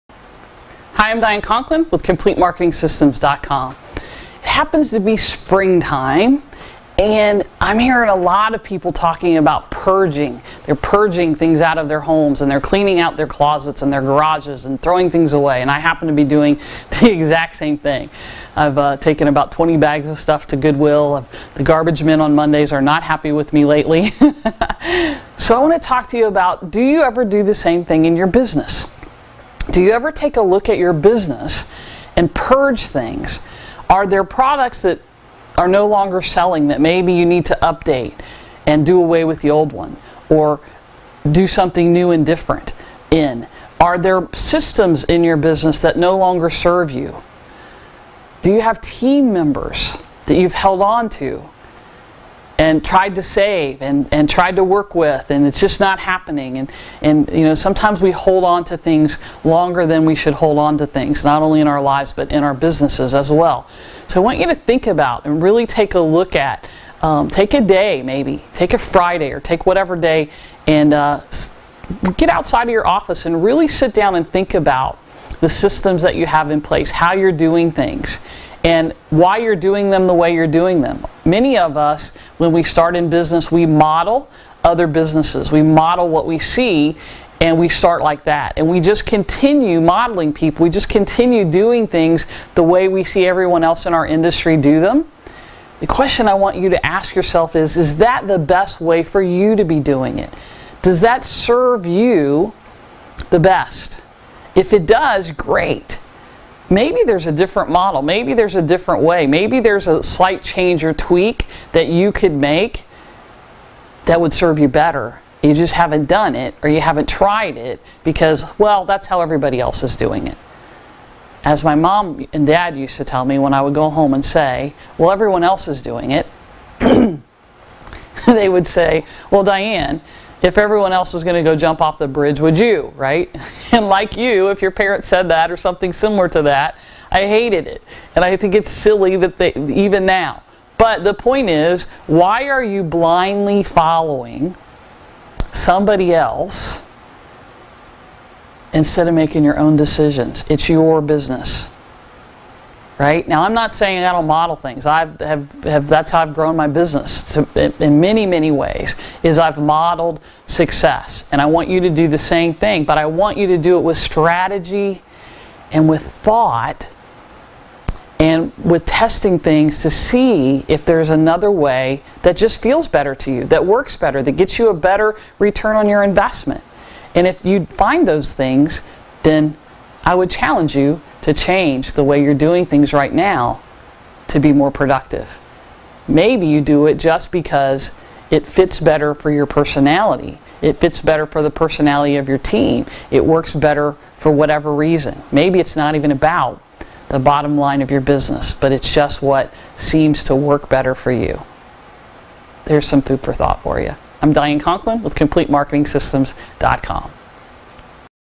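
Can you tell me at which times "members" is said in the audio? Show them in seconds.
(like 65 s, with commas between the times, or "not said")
49 s.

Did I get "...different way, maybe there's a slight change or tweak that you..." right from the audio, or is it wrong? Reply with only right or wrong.
right.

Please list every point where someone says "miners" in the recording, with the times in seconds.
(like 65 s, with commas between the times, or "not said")
not said.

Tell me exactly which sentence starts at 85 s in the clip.
We model what we see and we start like that.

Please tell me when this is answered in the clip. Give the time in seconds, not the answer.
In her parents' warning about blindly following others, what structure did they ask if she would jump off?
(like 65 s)
131 s.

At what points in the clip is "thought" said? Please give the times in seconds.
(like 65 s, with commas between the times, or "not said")
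166 s, 203 s.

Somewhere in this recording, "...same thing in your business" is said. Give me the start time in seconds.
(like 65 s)
27 s.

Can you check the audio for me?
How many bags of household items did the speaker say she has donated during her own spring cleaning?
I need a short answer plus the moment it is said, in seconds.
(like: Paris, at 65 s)
20, at 19 s.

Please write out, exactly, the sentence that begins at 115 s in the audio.
You just haven't done it or you haven't tried it because, well, that's how everybody else is doing it.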